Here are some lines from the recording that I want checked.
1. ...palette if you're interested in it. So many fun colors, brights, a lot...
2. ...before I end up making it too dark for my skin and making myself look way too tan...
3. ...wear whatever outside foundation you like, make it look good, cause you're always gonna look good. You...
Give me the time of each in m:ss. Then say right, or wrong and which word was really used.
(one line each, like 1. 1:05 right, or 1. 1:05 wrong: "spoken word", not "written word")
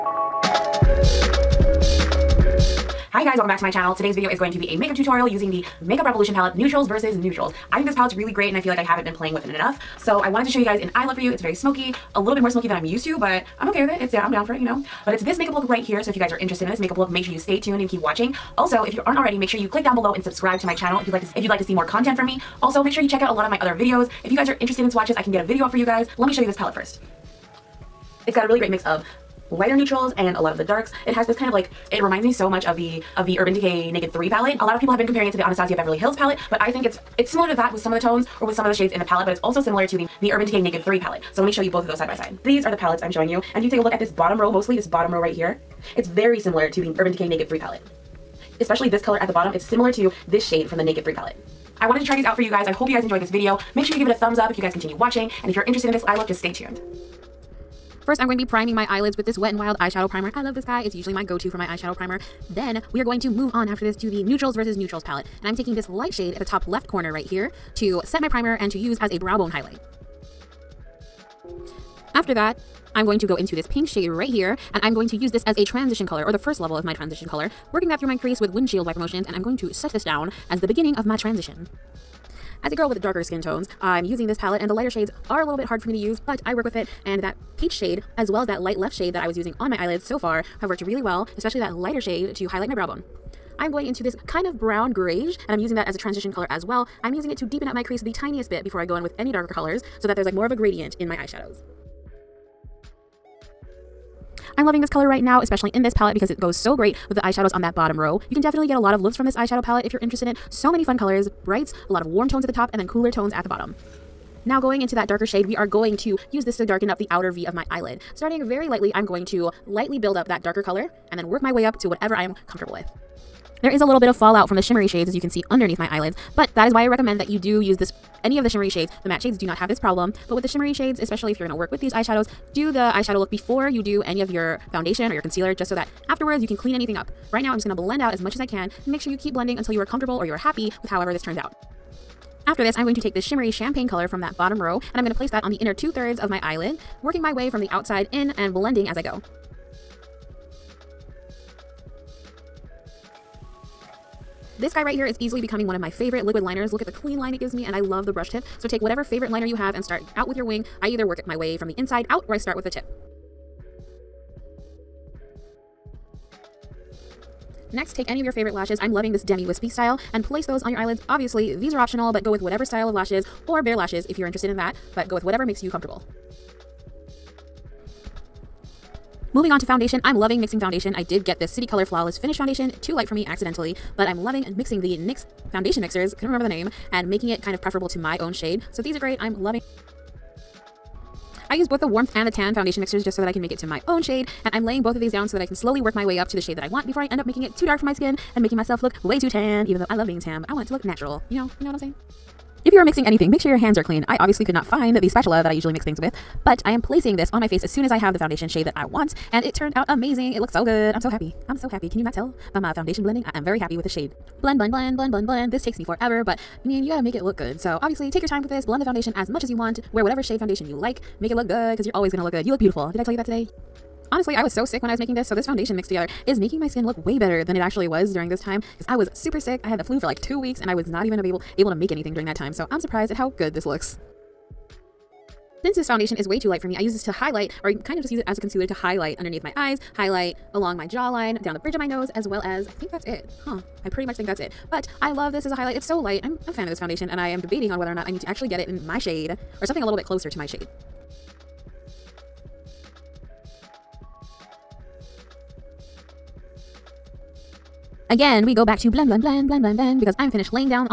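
1. 1:49 right
2. 3:16 right
3. 3:39 wrong: "shade", not "outside".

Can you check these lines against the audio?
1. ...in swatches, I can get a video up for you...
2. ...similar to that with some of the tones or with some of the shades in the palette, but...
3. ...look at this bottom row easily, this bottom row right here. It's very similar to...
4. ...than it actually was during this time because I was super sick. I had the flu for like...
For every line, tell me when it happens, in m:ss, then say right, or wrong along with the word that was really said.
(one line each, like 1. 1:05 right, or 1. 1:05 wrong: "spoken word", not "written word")
1. 0:24 right
2. 0:37 right
3. 0:43 wrong: "mostly", not "easily"
4. 3:47 right.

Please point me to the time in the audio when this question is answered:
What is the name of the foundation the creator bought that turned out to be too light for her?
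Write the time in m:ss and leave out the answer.
3:01.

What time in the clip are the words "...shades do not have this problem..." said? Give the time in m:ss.
2:09.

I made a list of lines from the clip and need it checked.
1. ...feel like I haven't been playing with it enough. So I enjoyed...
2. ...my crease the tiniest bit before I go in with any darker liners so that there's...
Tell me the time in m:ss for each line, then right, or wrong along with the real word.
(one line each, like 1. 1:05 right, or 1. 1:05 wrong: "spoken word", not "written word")
1. 0:08 wrong: "wanted", not "enjoyed"
2. 1:37 wrong: "colors", not "liners".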